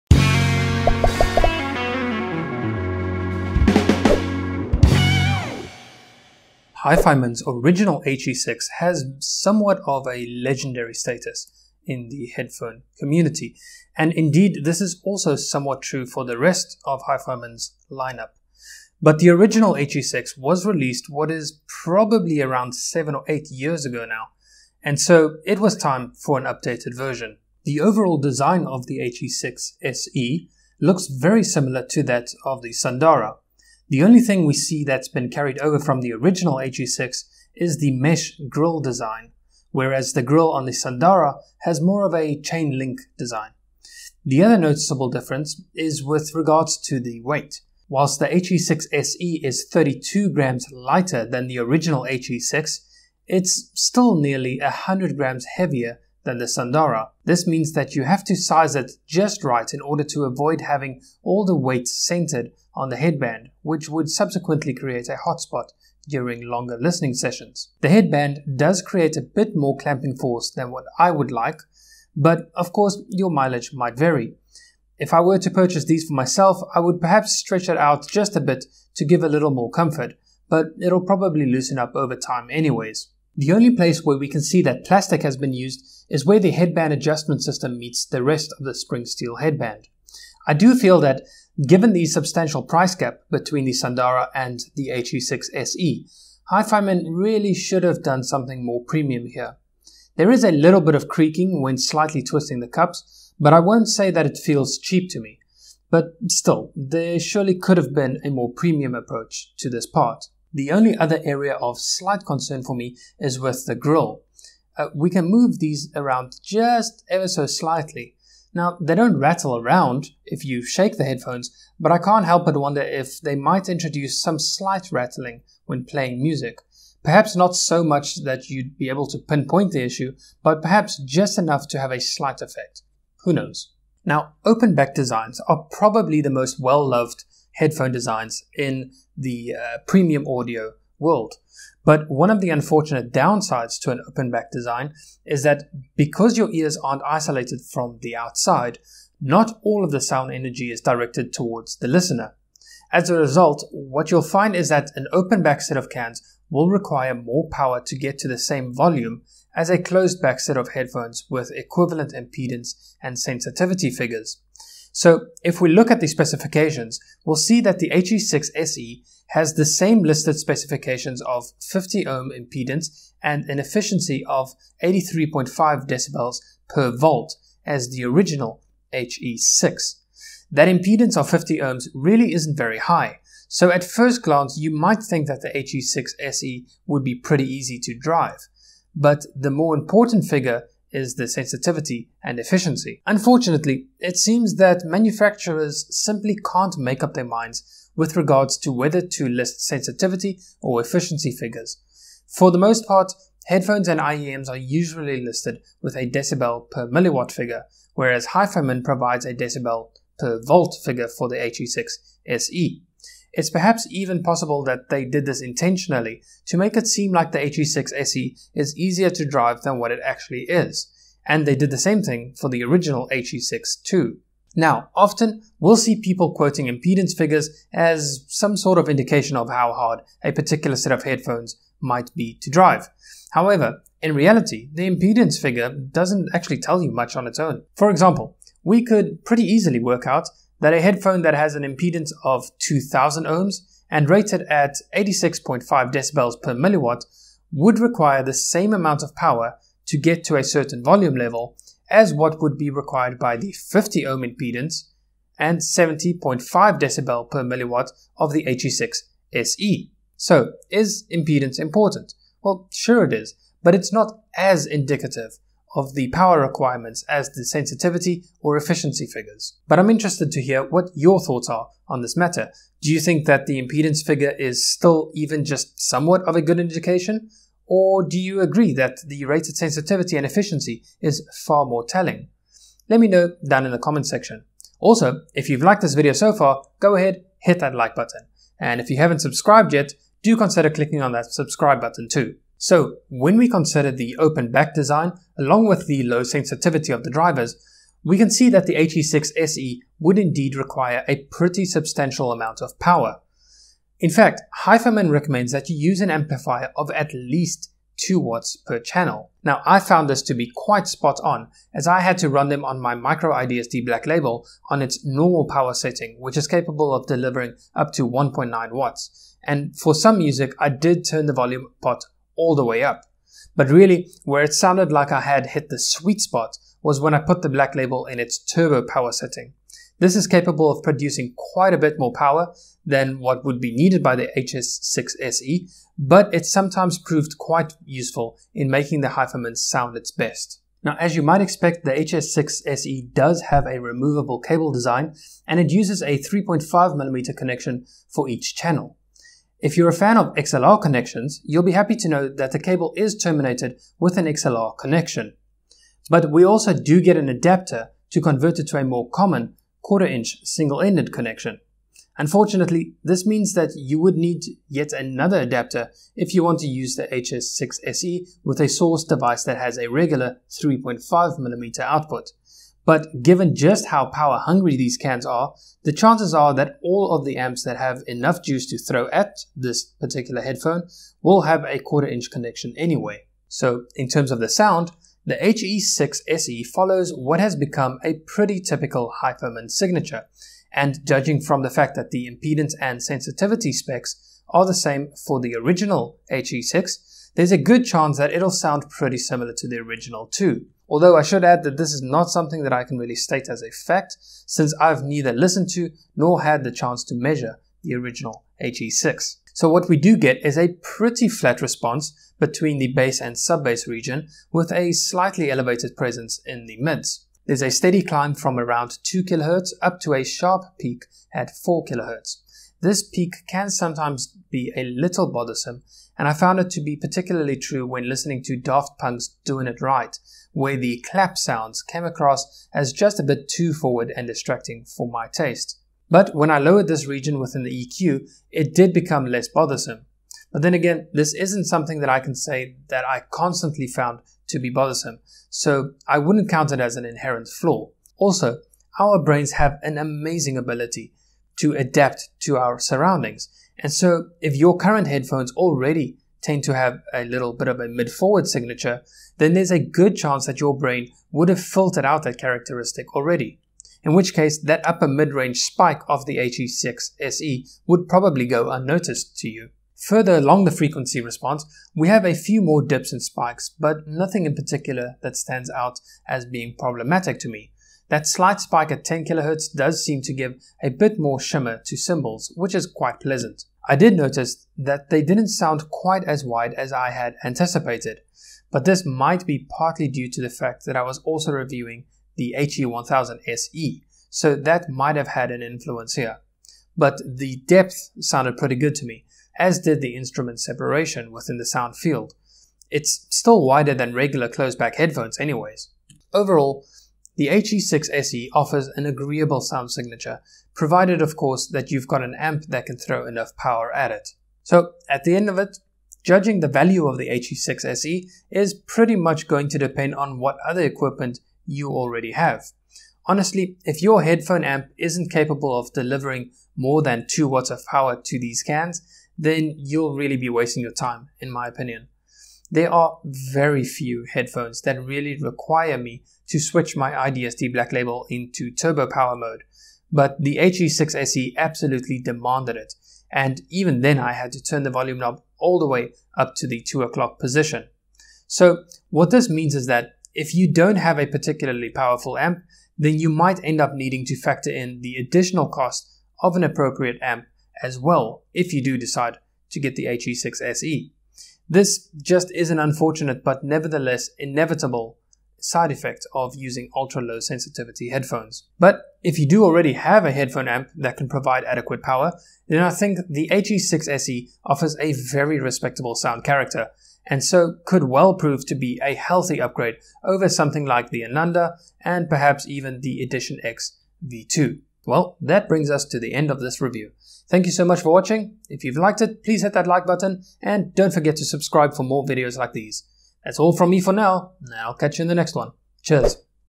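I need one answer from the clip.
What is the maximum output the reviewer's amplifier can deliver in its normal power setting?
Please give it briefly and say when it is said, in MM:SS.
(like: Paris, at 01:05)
1.9 watts, at 05:18.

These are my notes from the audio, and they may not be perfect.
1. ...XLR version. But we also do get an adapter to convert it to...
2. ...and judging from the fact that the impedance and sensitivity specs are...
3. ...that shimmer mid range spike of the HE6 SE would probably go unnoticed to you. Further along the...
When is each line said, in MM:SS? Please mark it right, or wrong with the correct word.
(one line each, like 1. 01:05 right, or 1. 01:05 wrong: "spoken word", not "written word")
1. 05:54 wrong: "connection", not "version"
2. 06:30 right
3. 07:44 wrong: "upper", not "shimmer".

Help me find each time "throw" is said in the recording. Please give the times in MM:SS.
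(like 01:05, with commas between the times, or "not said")
06:18, 08:32.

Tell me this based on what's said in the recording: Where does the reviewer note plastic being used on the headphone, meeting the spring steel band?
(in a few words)
headband adjustment system.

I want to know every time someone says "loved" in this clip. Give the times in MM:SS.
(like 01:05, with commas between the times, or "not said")
02:16.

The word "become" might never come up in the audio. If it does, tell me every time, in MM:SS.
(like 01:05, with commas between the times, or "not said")
06:27, 07:18.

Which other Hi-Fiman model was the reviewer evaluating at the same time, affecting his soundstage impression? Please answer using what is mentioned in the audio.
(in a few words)
HE1000 SE.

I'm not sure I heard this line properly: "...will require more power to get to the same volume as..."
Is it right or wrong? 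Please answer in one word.
right.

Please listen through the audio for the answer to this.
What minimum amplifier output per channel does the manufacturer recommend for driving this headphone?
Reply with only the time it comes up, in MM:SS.
05:08.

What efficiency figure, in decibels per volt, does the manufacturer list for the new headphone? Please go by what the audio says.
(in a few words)
83.5.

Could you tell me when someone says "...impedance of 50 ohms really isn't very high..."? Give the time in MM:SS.
03:00.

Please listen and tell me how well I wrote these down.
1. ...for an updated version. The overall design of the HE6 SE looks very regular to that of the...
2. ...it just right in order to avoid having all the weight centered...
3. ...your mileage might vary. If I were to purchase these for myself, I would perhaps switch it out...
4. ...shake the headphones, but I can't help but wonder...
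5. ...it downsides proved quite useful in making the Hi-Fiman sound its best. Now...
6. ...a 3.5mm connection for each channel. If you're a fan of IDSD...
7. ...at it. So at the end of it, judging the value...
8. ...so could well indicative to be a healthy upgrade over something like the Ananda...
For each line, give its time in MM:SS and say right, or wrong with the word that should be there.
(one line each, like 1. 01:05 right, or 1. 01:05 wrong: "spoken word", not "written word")
1. 00:26 wrong: "similar", not "regular"
2. 00:58 right
3. 01:13 wrong: "stretch", not "switch"
4. 02:00 right
5. 05:36 wrong: "sometimes", not "downsides"
6. 05:46 wrong: "XLR", not "IDSD"
7. 08:33 right
8. 09:37 wrong: "prove", not "indicative".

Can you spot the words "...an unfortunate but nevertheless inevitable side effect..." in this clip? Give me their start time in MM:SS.
09:22.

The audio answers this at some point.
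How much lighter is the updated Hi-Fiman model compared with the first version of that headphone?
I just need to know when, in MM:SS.
00:49.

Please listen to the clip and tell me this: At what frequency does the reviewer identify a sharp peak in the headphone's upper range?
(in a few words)
4 kHz.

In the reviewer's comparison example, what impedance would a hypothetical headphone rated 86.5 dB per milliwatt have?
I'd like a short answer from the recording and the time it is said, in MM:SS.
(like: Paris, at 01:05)
2000 ohms, at 04:02.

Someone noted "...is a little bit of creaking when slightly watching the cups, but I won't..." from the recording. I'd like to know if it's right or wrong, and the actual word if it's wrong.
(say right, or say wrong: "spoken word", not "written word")
wrong: "twisting", not "watching".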